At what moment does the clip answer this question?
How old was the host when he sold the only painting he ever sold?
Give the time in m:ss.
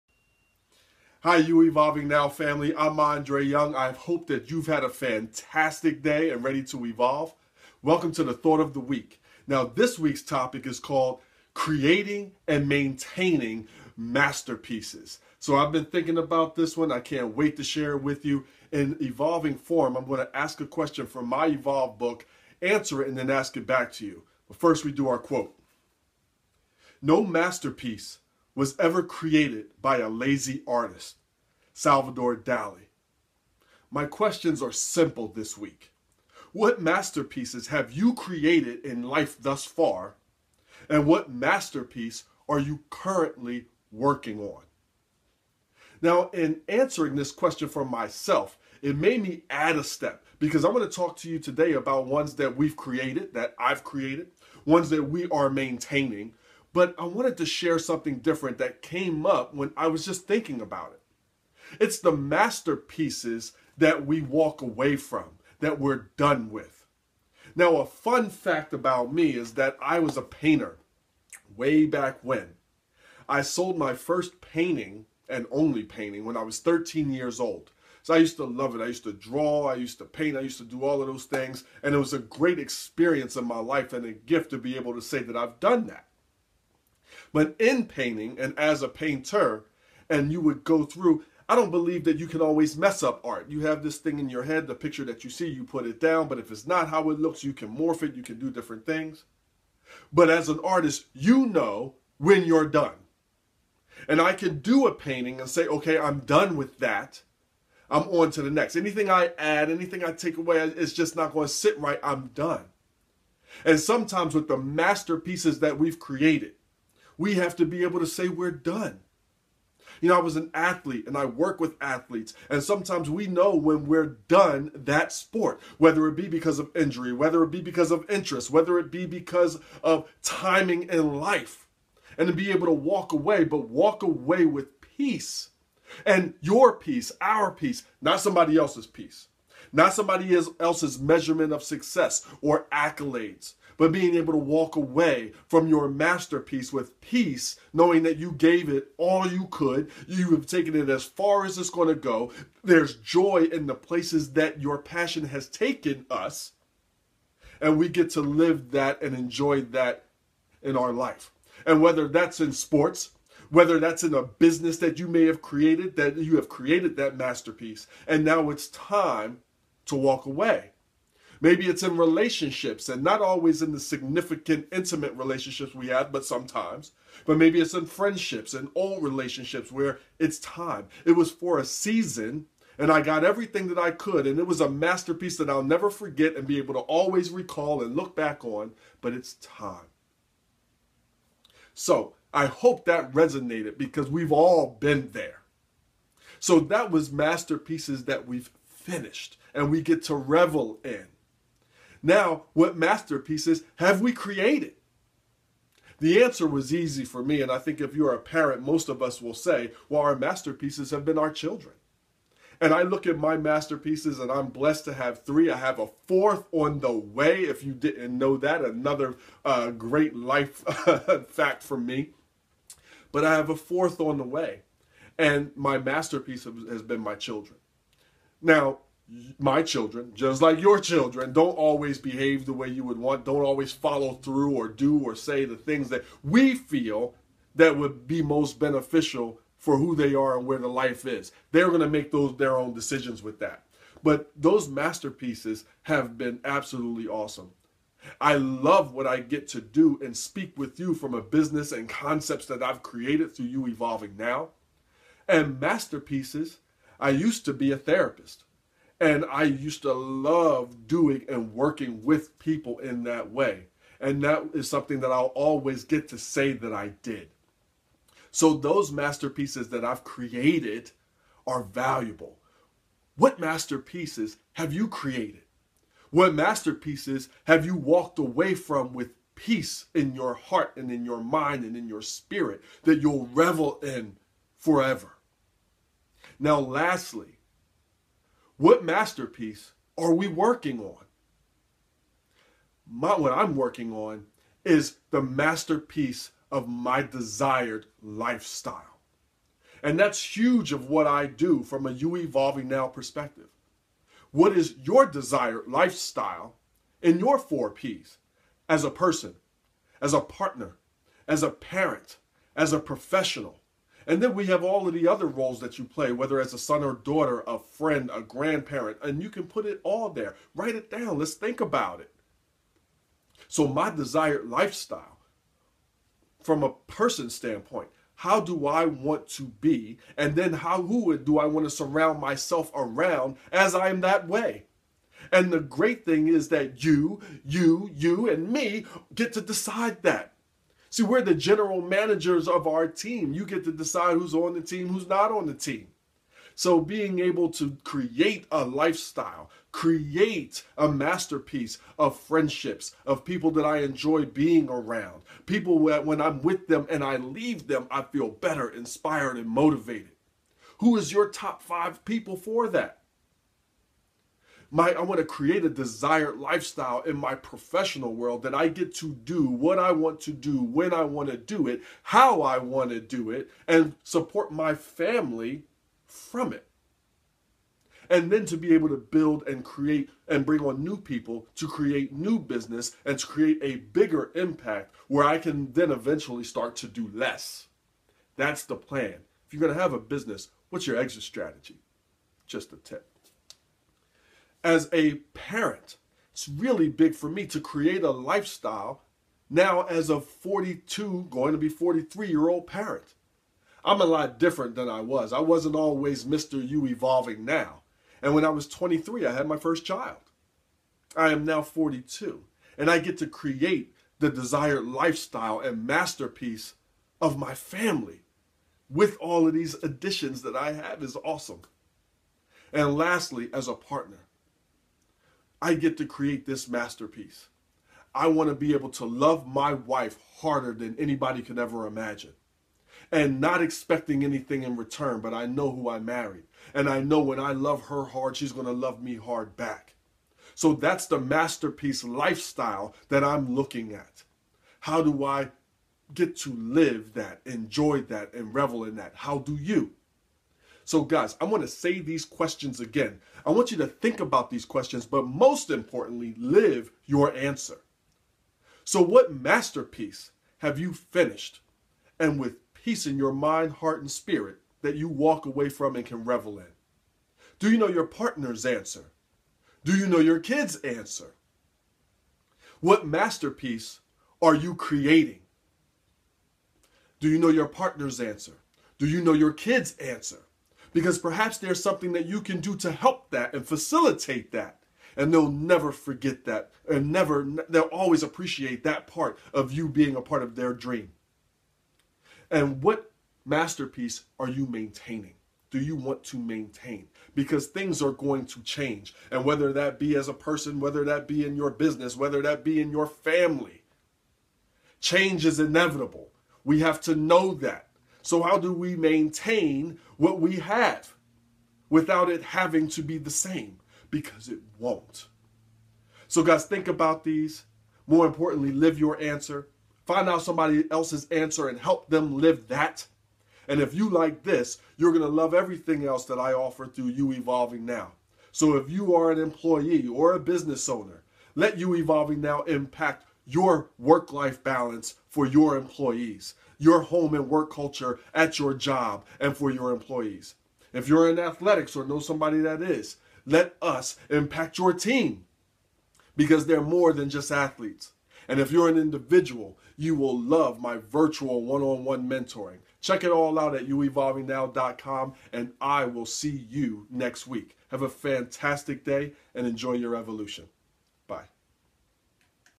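1:16.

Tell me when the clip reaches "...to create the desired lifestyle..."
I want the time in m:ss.
6:53.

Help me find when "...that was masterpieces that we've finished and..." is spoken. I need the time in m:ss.
3:16.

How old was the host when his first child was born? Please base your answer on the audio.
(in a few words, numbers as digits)
23.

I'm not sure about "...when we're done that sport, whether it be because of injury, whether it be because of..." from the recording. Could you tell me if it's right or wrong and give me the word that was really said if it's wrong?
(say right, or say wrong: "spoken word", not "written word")
right.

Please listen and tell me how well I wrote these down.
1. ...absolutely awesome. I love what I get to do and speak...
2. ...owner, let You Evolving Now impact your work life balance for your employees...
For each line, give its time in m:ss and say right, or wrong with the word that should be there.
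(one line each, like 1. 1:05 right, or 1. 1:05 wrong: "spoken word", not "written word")
1. 4:06 right
2. 8:50 right.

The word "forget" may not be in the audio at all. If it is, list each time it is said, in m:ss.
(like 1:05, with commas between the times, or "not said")
3:05, 8:05.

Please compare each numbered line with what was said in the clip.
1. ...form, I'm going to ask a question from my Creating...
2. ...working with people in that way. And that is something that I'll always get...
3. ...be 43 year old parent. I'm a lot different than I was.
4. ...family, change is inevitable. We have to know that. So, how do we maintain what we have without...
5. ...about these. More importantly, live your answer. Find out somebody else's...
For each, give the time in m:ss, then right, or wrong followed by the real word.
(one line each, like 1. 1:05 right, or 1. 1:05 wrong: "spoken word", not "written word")
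1. 0:19 wrong: "Evolve", not "Creating"
2. 4:21 right
3. 6:41 right
4. 8:23 right
5. 8:36 right.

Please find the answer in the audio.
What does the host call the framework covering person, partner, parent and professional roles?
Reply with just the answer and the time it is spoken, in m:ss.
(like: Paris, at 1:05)
four P's, at 5:07.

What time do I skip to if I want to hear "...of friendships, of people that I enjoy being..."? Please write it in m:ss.
5:51.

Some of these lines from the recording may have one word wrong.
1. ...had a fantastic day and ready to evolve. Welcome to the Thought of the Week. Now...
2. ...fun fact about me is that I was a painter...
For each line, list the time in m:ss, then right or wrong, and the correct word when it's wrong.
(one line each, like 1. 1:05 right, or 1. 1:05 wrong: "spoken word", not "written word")
1. 0:04 right
2. 1:07 right.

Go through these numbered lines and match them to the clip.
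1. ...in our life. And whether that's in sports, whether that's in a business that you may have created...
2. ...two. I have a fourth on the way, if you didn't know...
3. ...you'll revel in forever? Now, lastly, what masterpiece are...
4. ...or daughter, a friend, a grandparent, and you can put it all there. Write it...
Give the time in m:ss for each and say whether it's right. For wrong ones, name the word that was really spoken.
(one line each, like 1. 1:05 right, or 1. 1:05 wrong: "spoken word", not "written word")
1. 2:40 right
2. 3:35 wrong: "three", not "two"
3. 4:43 right
4. 5:16 right.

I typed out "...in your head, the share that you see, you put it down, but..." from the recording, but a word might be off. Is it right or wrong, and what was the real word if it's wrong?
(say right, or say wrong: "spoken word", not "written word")
wrong: "picture", not "share".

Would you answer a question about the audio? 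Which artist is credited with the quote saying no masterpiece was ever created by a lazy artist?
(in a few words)
Salvador Dali.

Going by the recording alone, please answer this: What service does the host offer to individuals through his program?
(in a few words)
virtual one on one mentoring.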